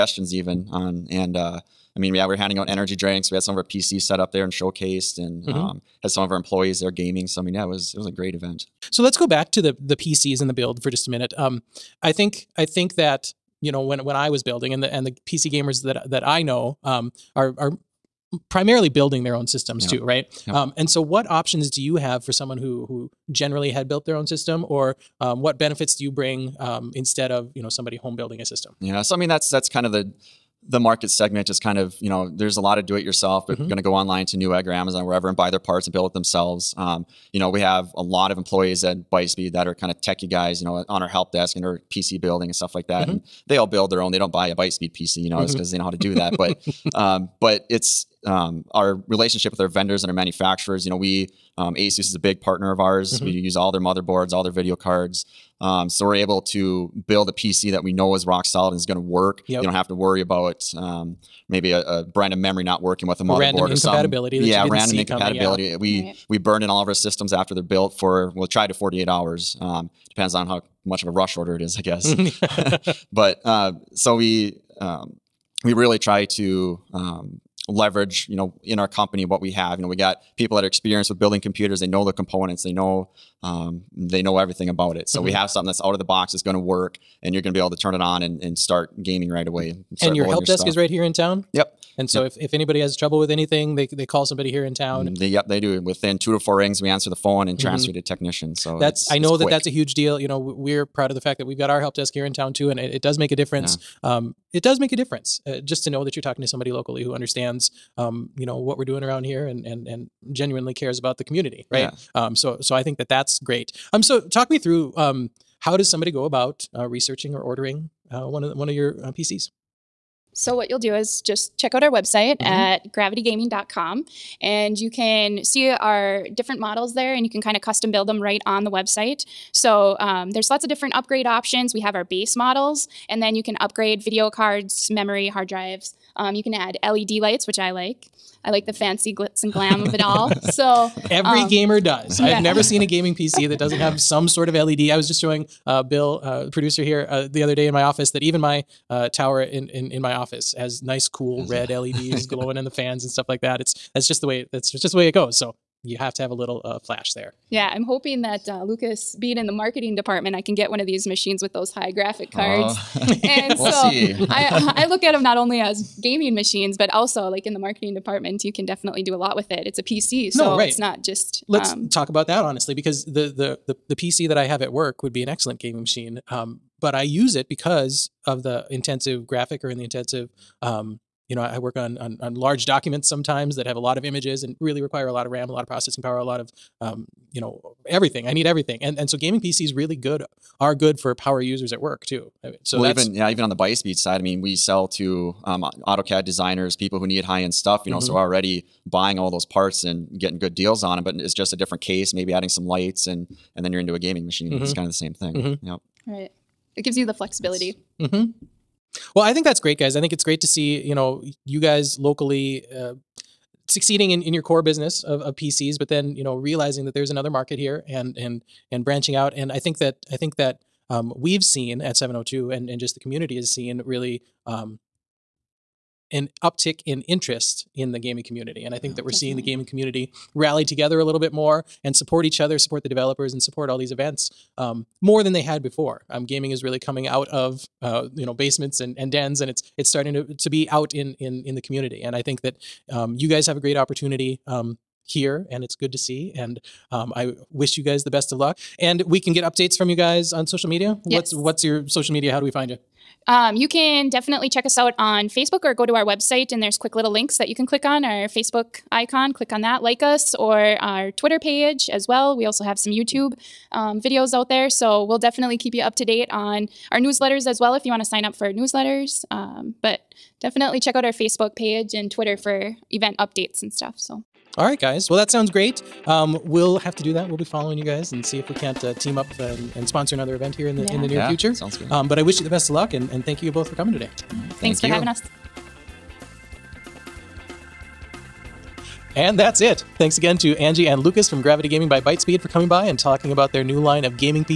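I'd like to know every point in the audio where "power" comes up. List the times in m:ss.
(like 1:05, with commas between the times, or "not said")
3:06, 3:11.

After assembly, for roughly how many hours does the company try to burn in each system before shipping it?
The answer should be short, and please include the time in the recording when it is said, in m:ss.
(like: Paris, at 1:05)
48, at 1:08.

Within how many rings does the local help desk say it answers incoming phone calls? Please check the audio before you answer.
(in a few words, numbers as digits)
2 to 4.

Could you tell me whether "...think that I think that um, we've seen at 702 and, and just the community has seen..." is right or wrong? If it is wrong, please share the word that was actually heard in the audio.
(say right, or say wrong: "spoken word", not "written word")
right.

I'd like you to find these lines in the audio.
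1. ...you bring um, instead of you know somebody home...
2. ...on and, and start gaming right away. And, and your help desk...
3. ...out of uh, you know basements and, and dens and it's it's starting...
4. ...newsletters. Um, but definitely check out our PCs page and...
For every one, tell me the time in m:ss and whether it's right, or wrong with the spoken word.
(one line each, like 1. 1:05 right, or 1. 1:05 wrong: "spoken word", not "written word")
1. 0:26 right
2. 1:27 right
3. 3:57 right
4. 4:28 wrong: "Facebook", not "PCs".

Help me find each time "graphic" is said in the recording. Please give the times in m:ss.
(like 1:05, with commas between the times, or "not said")
2:41, 2:59.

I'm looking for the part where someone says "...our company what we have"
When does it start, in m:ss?
1:18.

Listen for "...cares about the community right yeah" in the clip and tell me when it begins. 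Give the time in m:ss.
1:50.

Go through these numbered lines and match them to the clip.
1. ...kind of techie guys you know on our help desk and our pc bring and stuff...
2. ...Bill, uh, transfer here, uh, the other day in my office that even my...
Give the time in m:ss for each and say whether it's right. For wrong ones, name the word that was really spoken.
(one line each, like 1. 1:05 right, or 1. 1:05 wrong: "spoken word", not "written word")
1. 0:39 wrong: "building", not "bring"
2. 2:25 wrong: "producer", not "transfer".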